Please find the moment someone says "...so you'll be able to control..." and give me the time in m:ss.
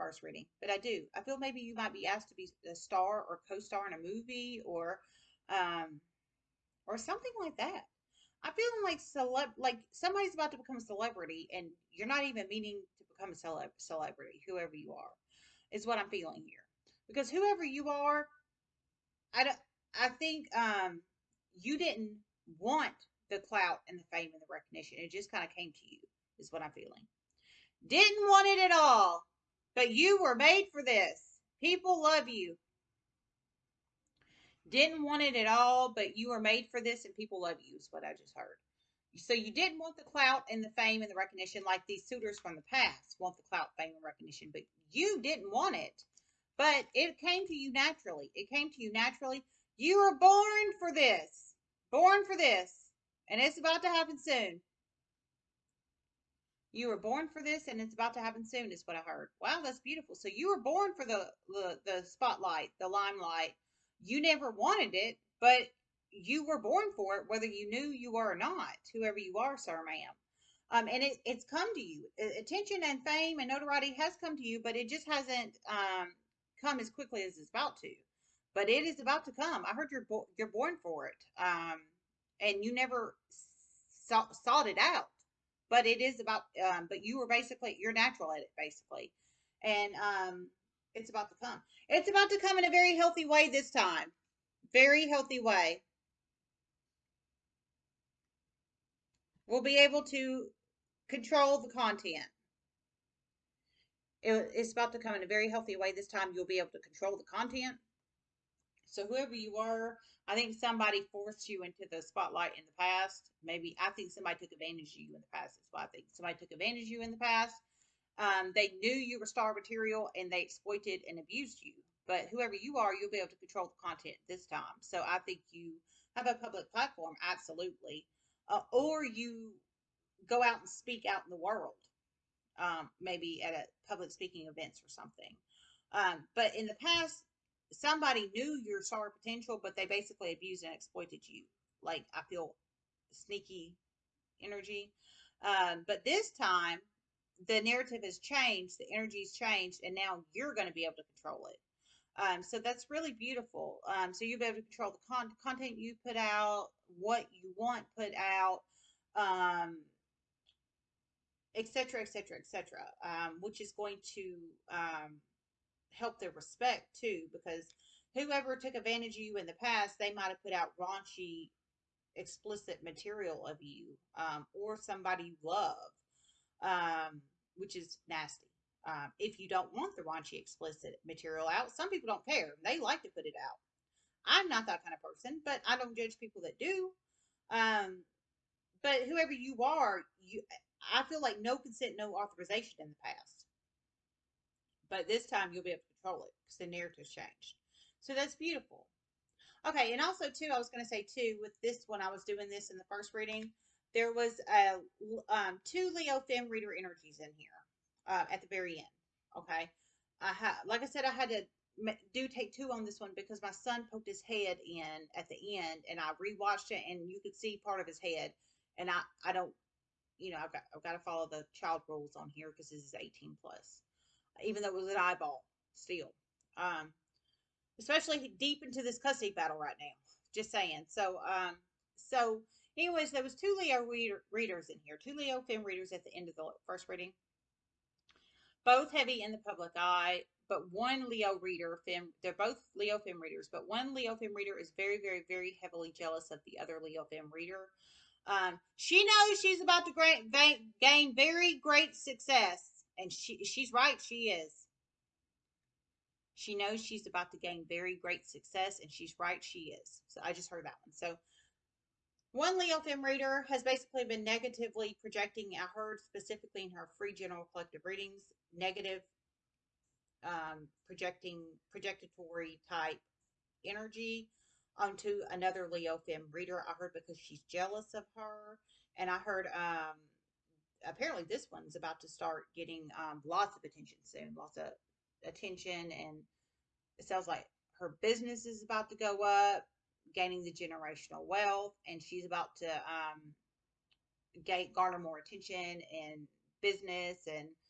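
2:34.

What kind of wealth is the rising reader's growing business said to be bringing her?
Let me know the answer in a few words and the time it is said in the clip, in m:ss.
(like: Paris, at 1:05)
Generational wealth, at 4:50.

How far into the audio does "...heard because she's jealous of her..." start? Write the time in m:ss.
4:36.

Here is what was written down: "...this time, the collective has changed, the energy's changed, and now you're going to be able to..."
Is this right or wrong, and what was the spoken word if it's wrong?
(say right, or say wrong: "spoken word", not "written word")
wrong: "narrative", not "collective".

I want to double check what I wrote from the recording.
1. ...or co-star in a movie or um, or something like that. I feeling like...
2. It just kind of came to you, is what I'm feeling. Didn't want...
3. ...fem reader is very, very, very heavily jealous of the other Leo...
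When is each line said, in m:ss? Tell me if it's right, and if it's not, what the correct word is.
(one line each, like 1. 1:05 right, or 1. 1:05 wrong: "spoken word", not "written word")
1. 0:03 right
2. 0:25 right
3. 4:04 right.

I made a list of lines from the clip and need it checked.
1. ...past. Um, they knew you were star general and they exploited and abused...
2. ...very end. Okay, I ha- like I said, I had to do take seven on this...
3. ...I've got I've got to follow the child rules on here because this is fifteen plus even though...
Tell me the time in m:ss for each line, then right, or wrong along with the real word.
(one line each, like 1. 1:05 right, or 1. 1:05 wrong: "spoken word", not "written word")
1. 1:57 wrong: "material", not "general"
2. 3:28 wrong: "two", not "seven"
3. 3:40 wrong: "eighteen", not "fifteen".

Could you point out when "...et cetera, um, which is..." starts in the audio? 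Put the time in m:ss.
2:42.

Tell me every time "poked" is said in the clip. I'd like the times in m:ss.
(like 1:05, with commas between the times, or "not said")
3:33.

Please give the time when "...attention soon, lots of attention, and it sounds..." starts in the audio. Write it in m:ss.
4:43.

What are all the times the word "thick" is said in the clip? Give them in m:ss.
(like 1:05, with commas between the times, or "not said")
not said.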